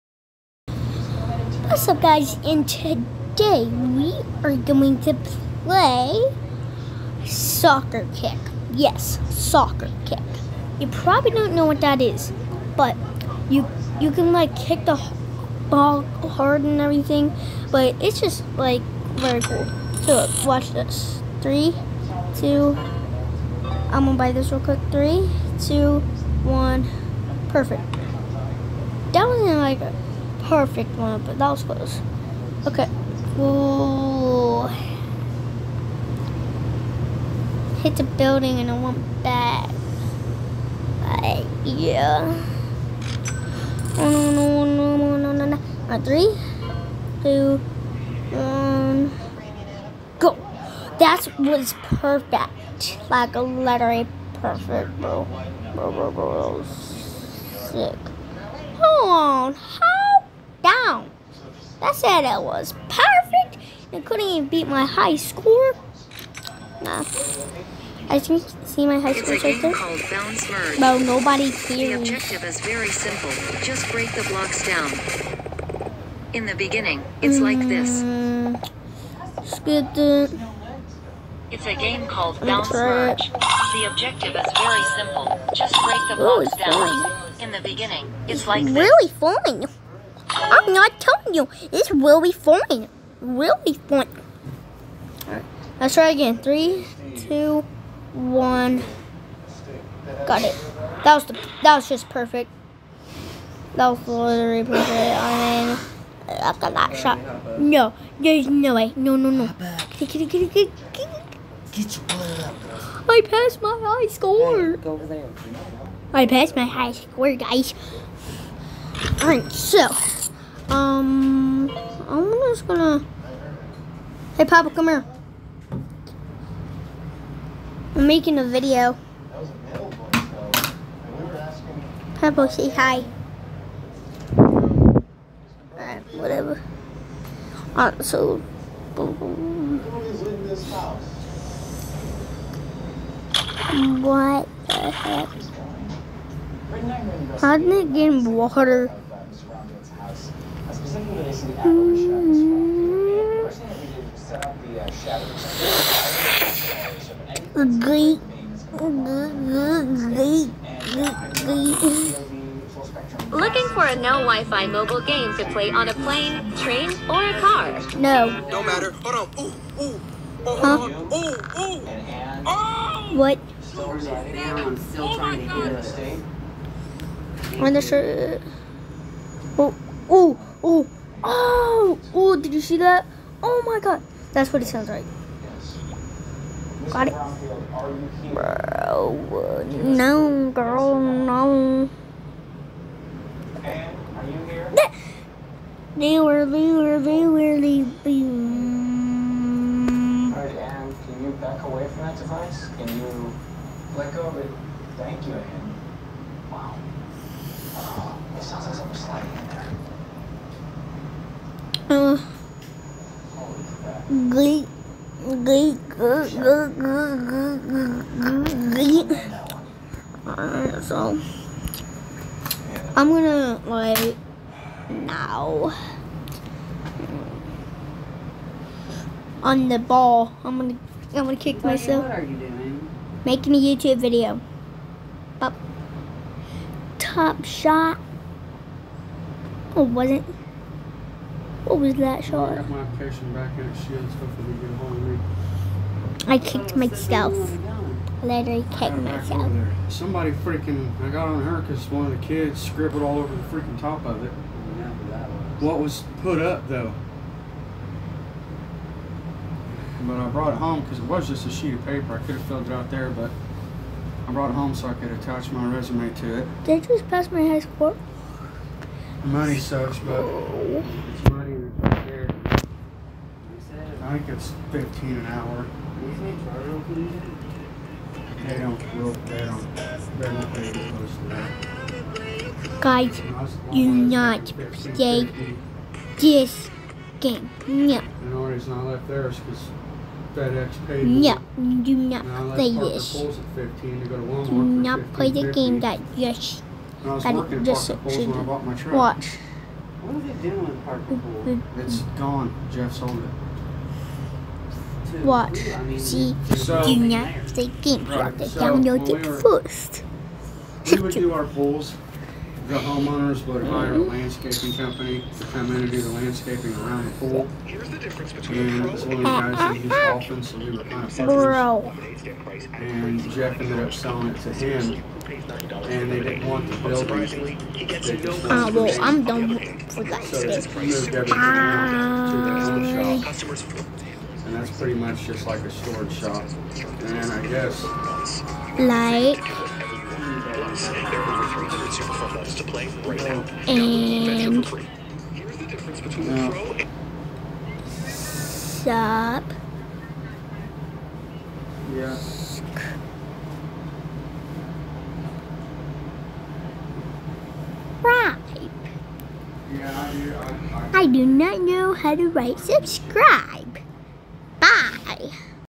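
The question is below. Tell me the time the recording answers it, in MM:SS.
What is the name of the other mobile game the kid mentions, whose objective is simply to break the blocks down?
01:22.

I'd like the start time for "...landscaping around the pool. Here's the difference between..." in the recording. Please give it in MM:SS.
05:16.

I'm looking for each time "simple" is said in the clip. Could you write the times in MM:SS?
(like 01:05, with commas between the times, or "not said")
01:12, 01:24.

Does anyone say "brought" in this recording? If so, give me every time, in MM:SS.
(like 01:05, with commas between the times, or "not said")
04:20, 04:24.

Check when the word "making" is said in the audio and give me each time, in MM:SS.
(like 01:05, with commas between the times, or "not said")
02:08, 03:53.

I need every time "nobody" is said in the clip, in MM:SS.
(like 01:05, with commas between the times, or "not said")
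01:10.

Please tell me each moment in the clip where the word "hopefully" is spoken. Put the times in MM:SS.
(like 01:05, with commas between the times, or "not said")
04:04.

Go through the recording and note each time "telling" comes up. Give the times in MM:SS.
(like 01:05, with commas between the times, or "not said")
01:30.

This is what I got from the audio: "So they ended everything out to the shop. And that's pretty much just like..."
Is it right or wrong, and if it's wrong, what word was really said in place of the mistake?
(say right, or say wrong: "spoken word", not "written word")
wrong: "moved", not "ended".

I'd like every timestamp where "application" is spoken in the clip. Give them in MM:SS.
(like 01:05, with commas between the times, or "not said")
04:02.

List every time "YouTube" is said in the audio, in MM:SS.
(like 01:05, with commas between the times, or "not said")
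03:53, 05:08.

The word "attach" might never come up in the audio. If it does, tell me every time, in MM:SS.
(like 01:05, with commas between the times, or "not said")
04:25.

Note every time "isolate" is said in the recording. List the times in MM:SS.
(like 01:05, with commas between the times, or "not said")
not said.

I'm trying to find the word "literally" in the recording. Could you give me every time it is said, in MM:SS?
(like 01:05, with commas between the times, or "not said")
00:53, 01:44, 04:08.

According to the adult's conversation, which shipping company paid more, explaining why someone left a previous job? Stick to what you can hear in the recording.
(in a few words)
FedEx.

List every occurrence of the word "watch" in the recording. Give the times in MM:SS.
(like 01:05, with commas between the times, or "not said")
00:20, 04:58, 05:05.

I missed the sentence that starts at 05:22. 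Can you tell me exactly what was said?
And Jeff ended up selling it to him.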